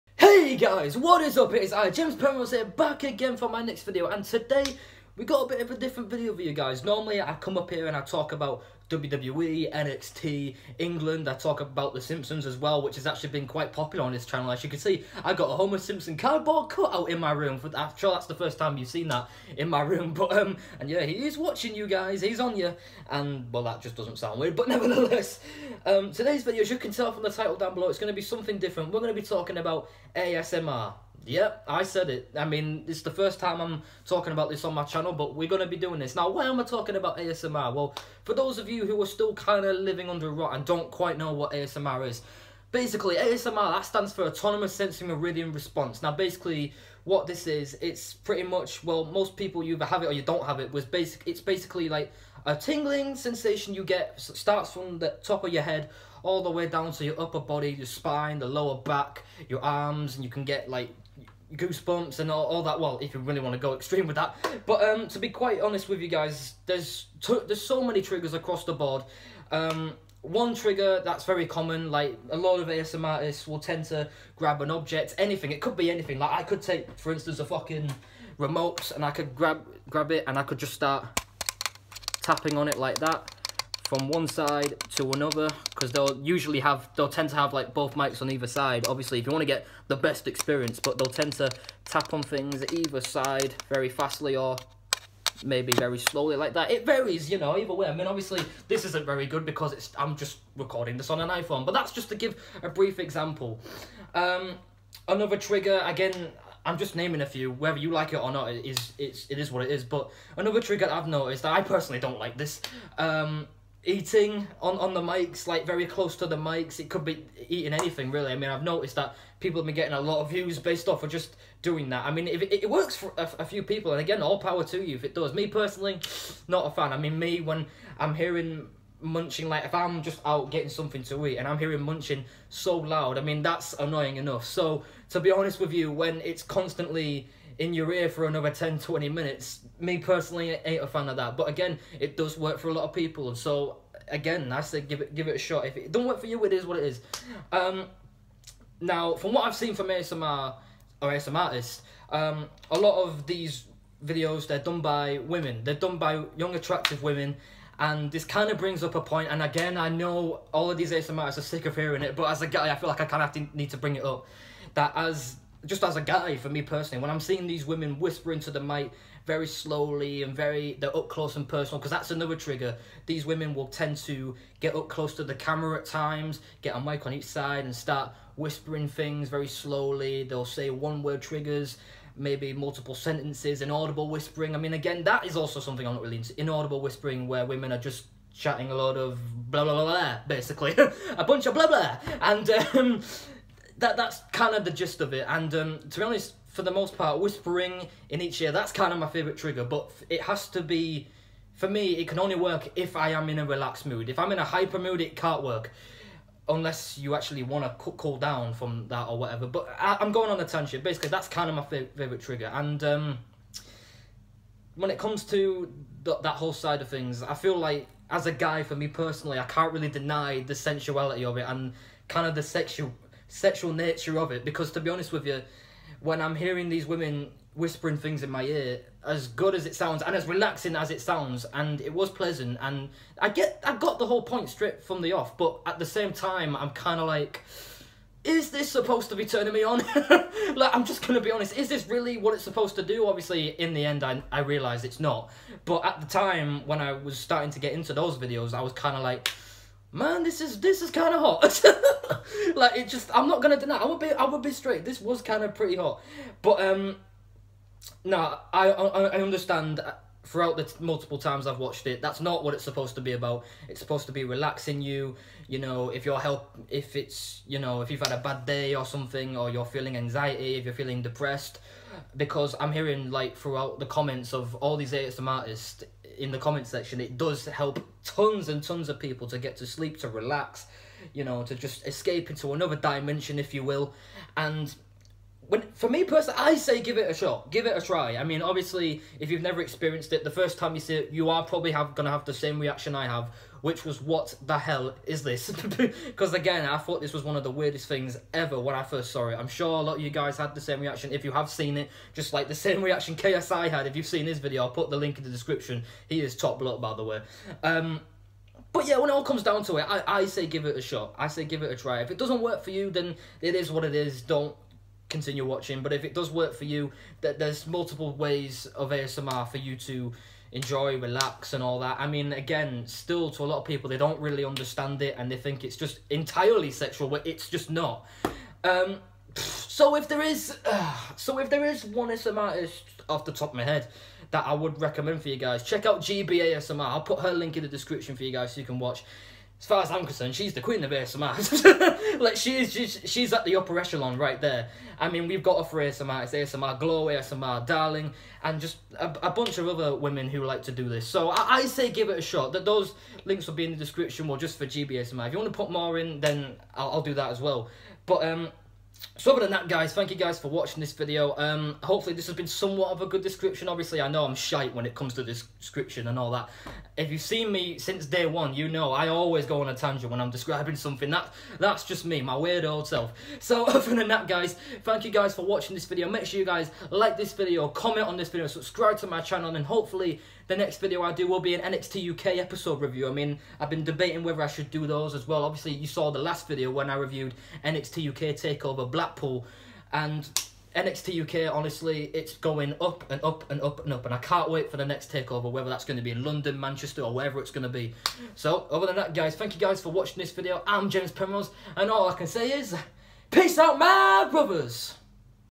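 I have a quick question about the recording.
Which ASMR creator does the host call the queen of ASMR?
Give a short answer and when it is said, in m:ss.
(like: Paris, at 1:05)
Gibi ASMR, at 5:36.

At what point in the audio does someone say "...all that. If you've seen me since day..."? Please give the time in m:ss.
6:06.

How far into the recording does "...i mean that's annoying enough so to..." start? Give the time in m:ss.
2:13.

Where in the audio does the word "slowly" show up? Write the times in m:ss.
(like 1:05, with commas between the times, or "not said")
1:35, 2:49, 2:59.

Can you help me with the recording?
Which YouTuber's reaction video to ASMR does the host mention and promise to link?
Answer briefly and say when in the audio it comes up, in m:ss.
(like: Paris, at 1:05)
KSI, at 5:03.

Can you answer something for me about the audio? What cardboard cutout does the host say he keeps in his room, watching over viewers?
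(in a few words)
Homer Simpson.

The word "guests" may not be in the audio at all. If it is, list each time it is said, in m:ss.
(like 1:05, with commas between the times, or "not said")
not said.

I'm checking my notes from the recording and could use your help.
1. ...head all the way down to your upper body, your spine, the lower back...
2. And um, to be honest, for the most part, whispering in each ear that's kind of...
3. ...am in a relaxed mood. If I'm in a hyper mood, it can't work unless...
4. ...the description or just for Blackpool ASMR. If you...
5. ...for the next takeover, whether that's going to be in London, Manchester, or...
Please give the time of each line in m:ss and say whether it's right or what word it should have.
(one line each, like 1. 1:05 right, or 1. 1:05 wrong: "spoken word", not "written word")
1. 0:55 right
2. 3:15 right
3. 3:23 right
4. 5:53 wrong: "Gibi", not "Blackpool"
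5. 6:34 right.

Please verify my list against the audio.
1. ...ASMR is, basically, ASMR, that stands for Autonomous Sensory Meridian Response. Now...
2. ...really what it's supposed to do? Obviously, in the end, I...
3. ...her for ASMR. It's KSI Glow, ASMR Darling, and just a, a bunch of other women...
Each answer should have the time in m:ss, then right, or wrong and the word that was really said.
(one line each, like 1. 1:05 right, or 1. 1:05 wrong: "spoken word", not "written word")
1. 0:41 right
2. 4:01 right
3. 5:45 wrong: "ASMR", not "KSI".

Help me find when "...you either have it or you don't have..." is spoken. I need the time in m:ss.
0:49.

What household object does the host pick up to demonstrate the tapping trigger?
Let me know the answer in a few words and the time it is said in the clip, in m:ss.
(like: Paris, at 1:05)
remote, at 1:18.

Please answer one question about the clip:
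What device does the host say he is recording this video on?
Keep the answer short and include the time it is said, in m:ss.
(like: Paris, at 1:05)
iPhone, at 1:41.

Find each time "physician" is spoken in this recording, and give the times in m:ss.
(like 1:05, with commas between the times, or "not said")
not said.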